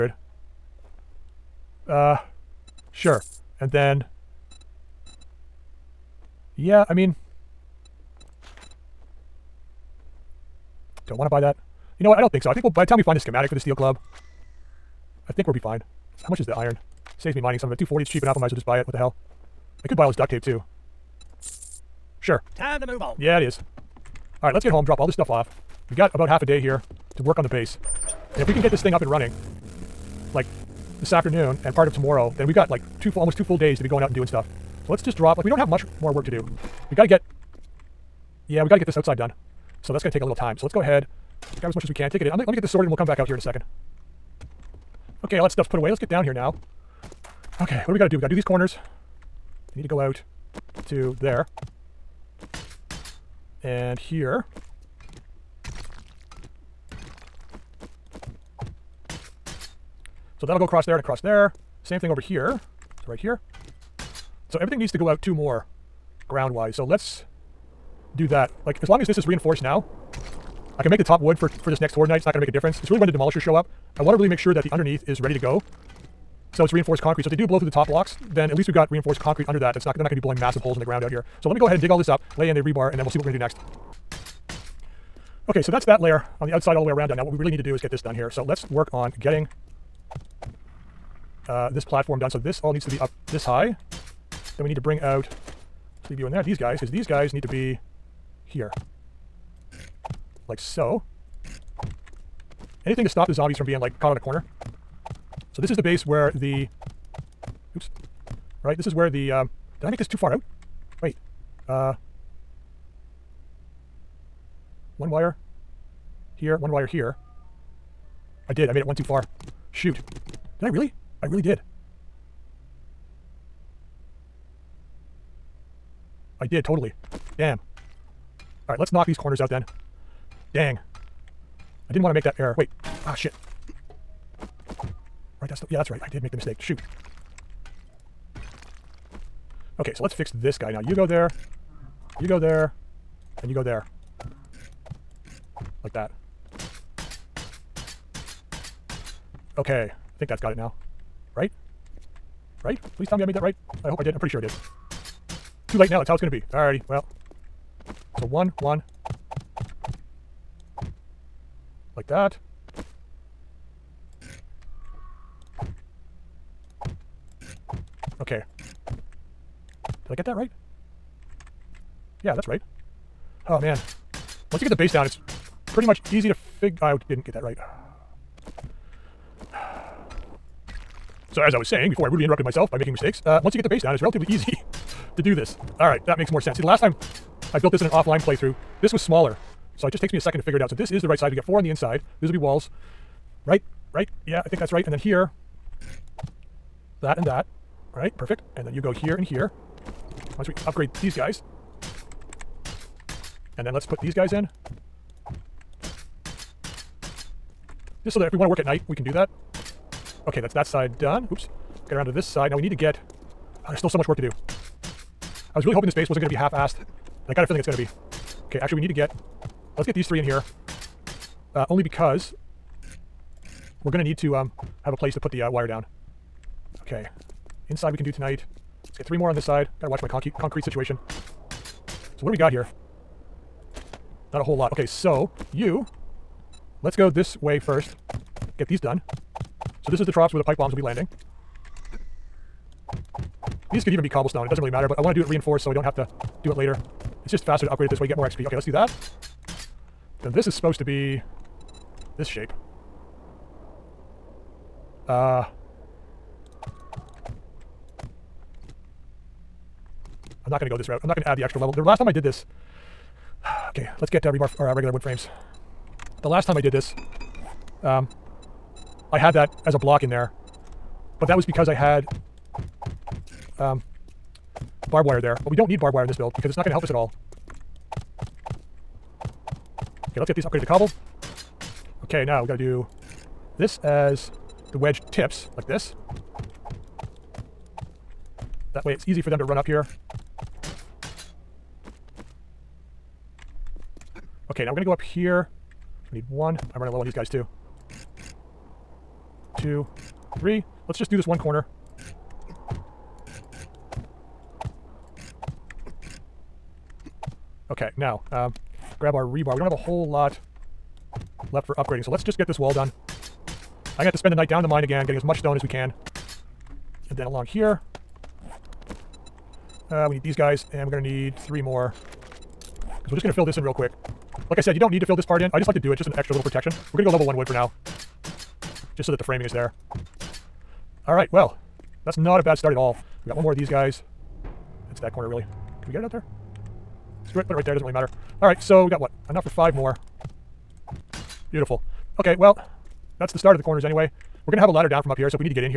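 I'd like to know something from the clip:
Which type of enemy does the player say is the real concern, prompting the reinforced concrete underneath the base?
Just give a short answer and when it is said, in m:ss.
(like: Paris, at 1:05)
Demolishers, at 1:13.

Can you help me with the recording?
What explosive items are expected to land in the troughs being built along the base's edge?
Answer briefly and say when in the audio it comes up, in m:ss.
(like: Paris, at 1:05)
pipe bombs, at 4:00.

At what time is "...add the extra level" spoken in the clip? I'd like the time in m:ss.
4:21.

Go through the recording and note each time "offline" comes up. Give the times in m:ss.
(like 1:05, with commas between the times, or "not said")
3:07.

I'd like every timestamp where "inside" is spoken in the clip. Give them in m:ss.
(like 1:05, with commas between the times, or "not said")
3:11, 3:47.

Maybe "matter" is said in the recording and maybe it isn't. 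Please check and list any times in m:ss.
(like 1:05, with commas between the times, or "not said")
4:04, 5:37.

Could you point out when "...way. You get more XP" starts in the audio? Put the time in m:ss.
4:07.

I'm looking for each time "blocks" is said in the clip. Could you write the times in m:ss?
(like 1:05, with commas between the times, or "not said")
1:17, 4:29.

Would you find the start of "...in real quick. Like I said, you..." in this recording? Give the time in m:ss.
5:23.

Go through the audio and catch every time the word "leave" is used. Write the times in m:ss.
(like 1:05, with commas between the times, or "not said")
1:36.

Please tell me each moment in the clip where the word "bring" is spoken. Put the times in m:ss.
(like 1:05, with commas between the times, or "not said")
1:34.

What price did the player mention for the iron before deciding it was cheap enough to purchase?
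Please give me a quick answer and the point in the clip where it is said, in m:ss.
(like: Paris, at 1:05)
240, at 0:17.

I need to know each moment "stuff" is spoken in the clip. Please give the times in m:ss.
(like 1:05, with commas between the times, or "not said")
0:25, 0:34, 0:45.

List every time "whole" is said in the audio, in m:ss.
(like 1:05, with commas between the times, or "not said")
3:54, 5:09.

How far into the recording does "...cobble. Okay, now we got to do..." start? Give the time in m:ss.
4:40.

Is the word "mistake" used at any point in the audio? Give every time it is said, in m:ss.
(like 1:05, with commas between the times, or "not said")
2:16, 3:02.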